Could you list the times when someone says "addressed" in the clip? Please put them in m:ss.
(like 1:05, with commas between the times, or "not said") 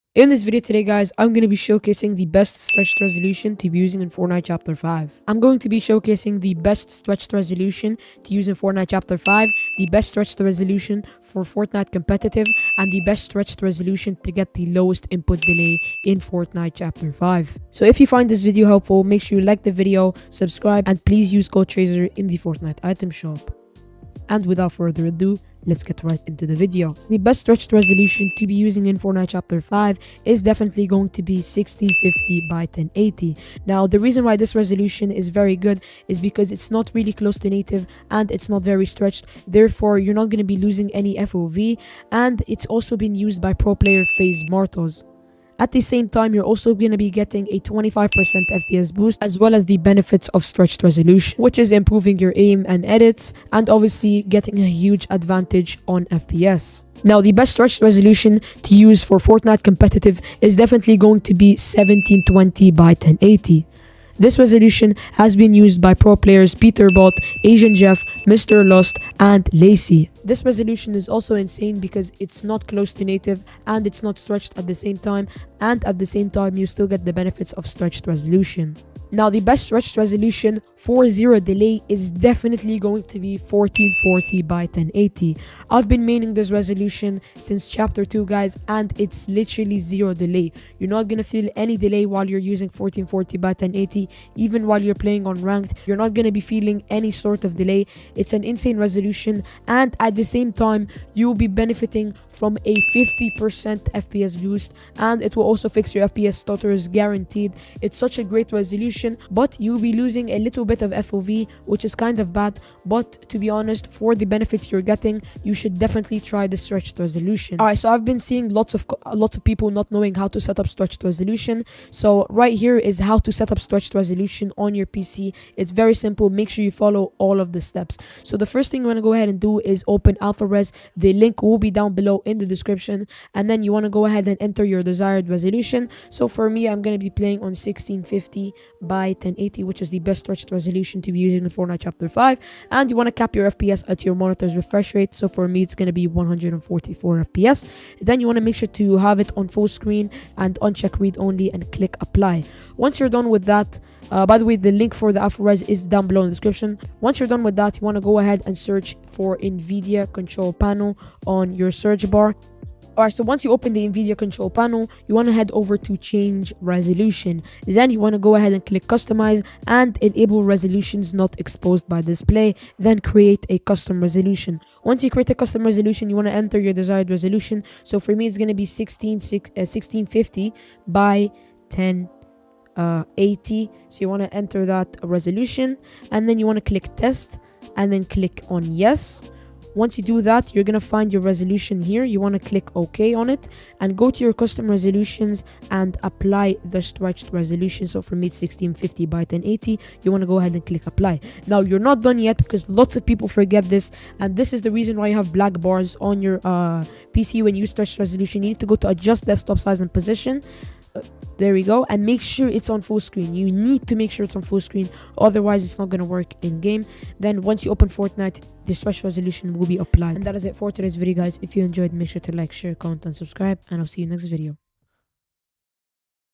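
not said.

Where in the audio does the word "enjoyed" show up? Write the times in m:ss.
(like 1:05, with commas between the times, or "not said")
3:41.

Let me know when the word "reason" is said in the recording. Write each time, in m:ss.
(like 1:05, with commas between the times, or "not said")
0:33, 3:24.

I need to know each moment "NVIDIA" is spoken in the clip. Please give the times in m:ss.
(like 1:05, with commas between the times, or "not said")
2:39, 2:43.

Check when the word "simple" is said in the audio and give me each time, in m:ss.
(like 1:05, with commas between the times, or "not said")
2:05.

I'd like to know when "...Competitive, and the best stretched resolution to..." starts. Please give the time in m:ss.
0:11.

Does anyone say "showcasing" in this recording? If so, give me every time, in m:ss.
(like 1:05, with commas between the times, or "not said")
0:01, 0:05.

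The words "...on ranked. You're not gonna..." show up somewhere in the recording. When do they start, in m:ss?
1:35.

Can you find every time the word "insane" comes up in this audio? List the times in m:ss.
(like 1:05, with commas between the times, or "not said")
1:11, 1:38.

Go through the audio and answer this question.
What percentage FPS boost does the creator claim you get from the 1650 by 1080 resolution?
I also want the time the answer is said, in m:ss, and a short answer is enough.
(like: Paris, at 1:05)
25%, at 0:47.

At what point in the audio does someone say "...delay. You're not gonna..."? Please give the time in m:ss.
1:30.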